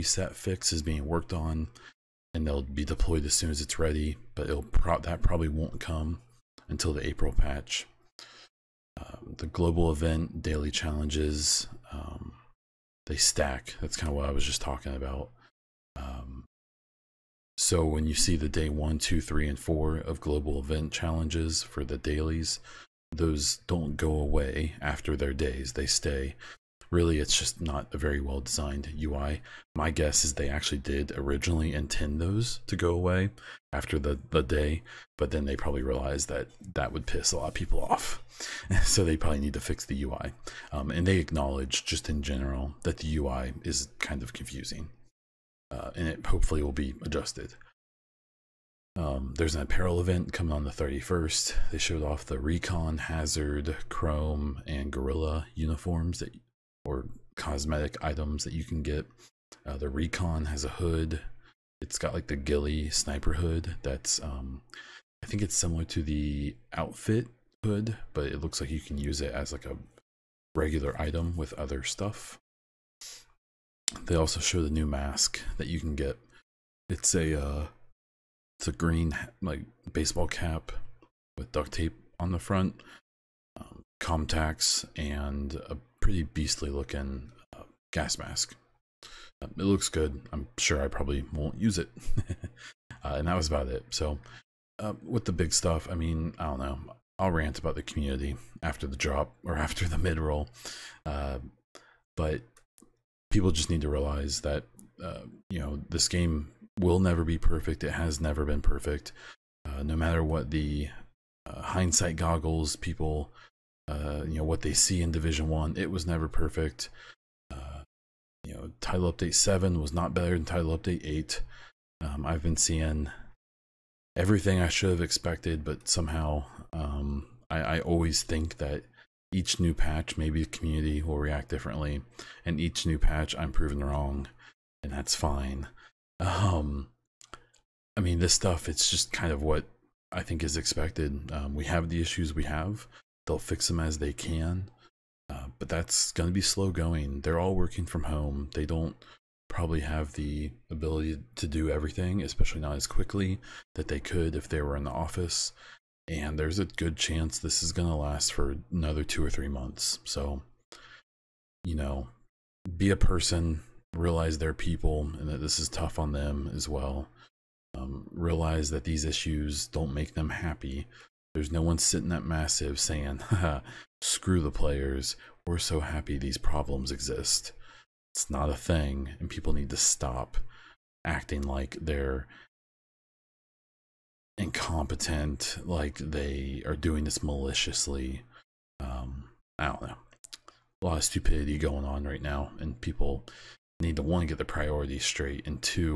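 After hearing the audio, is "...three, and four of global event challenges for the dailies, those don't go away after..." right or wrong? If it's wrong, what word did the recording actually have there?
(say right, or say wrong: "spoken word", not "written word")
right.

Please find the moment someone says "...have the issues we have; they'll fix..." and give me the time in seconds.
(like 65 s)
141 s.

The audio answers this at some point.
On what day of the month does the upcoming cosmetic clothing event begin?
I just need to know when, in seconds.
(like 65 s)
50 s.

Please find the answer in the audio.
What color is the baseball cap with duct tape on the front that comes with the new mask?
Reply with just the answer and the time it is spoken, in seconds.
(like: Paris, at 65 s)
Green, at 78 s.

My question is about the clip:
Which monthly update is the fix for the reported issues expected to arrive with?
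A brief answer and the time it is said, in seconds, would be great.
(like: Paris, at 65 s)
April patch, at 7 s.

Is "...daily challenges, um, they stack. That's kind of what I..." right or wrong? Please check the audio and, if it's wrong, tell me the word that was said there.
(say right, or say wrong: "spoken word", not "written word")
right.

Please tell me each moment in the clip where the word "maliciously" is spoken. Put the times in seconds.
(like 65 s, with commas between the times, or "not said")
187 s.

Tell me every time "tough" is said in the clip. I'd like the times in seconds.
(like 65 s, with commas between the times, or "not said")
165 s.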